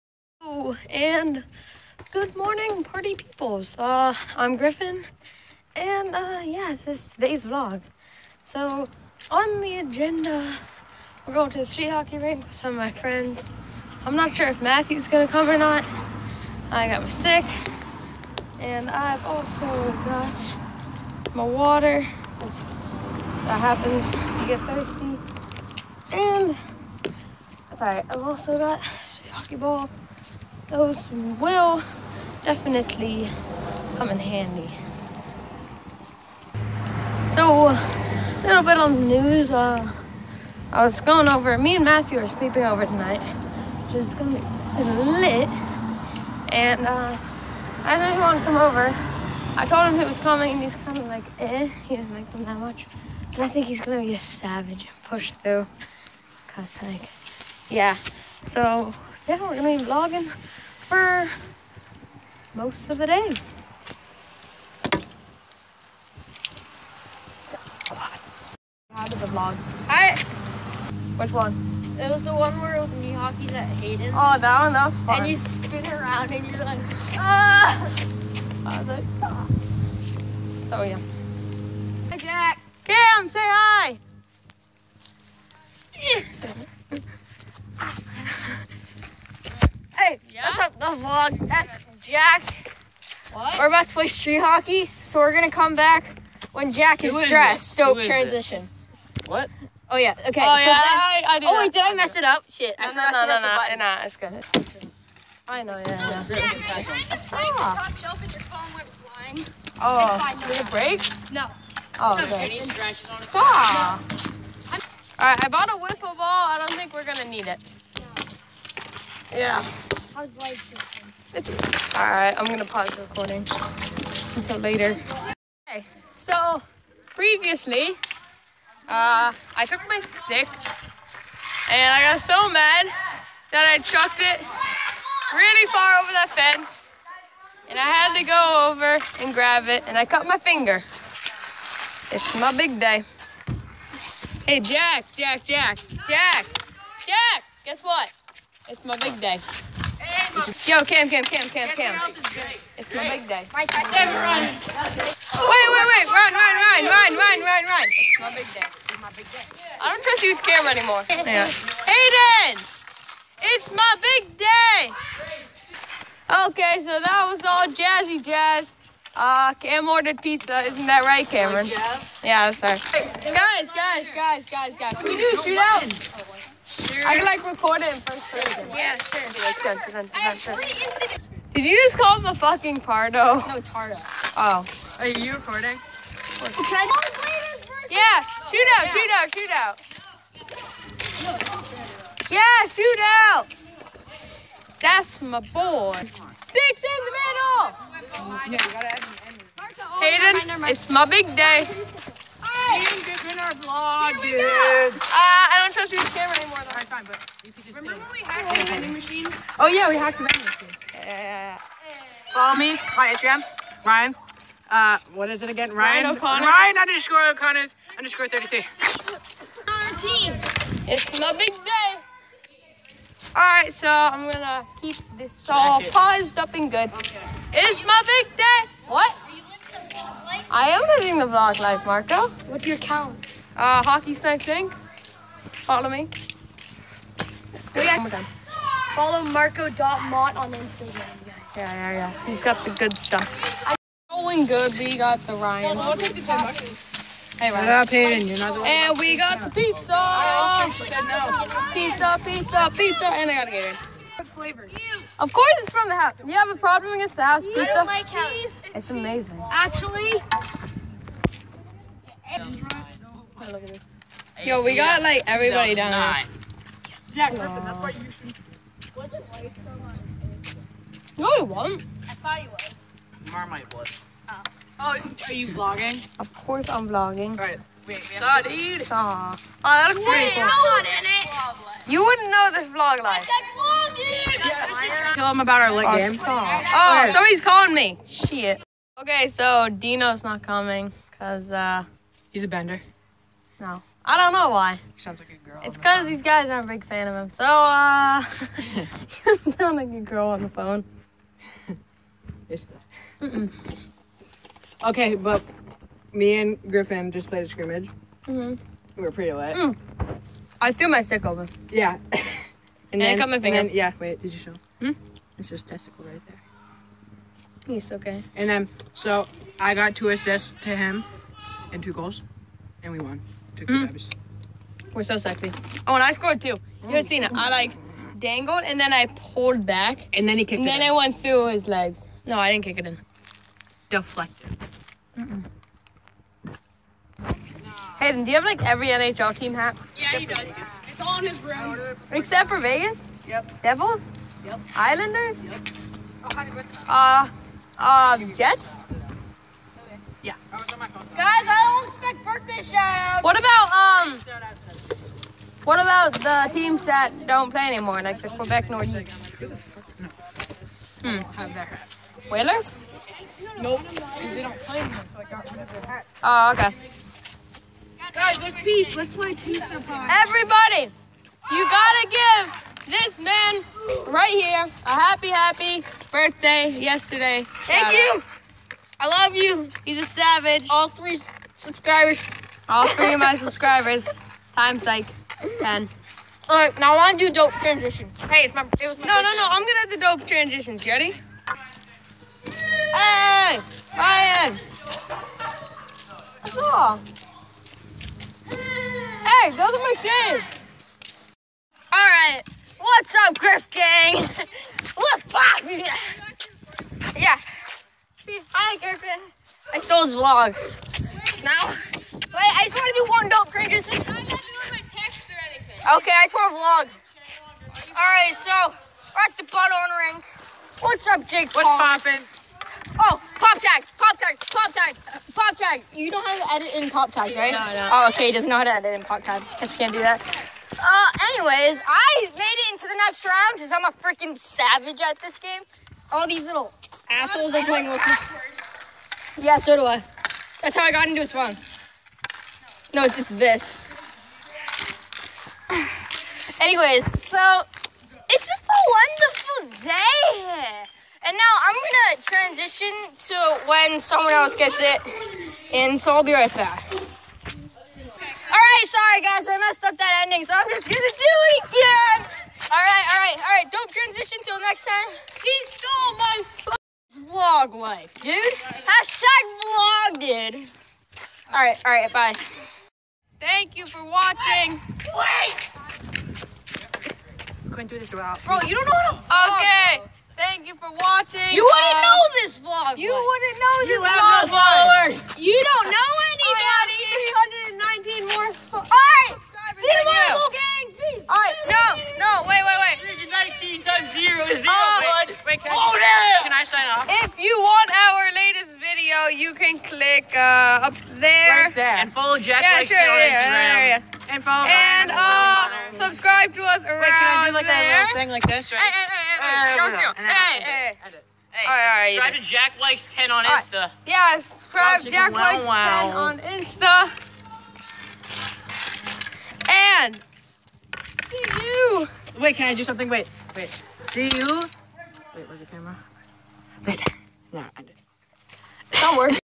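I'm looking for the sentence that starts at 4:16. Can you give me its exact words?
You have a problem against the house pizza?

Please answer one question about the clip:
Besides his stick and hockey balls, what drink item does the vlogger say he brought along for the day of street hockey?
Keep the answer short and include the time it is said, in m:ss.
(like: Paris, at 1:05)
water, at 0:21.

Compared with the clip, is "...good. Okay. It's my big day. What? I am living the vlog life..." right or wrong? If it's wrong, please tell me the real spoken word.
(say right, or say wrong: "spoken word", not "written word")
right.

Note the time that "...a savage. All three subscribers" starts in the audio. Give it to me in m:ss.
6:19.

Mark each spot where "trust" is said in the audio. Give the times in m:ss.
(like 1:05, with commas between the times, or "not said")
2:40, 3:25.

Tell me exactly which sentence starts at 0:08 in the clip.
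So, on the agenda, we're going to the street hockey rink with some of my friends.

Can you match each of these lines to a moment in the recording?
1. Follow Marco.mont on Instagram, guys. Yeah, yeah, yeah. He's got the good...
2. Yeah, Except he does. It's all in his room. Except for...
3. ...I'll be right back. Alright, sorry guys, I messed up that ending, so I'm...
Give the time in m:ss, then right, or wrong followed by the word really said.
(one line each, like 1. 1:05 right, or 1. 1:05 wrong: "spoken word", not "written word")
1. 3:58 right
2. 5:39 right
3. 7:36 right.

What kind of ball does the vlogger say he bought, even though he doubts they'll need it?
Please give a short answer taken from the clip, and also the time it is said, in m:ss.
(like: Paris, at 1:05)
wiffle ball, at 1:55.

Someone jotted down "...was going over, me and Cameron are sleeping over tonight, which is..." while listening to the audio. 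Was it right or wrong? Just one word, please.
wrong.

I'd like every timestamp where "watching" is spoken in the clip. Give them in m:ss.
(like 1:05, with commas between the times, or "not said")
7:54, 8:00.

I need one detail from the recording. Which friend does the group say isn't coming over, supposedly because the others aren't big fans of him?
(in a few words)
Dino.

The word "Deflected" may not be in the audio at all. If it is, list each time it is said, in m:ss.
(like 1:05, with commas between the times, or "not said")
5:33.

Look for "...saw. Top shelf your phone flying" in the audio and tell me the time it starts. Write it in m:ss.
1:47.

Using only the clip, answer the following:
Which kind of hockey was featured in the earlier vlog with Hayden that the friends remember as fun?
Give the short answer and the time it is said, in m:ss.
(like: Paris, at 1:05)
knee hockey, at 1:12.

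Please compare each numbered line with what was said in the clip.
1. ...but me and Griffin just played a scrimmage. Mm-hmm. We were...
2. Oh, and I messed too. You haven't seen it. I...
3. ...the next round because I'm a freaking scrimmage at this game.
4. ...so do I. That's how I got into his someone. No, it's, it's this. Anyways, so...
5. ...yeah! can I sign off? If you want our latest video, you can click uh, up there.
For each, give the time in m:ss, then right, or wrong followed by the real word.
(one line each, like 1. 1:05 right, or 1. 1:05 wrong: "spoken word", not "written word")
1. 5:05 right
2. 5:25 wrong: "scored", not "messed"
3. 7:12 wrong: "savage", not "scrimmage"
4. 7:19 wrong: "phone", not "someone"
5. 8:15 right.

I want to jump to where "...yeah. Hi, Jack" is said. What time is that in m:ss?
1:20.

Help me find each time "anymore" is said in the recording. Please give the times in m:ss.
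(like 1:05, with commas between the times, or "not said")
2:40, 3:26, 5:57, 6:04.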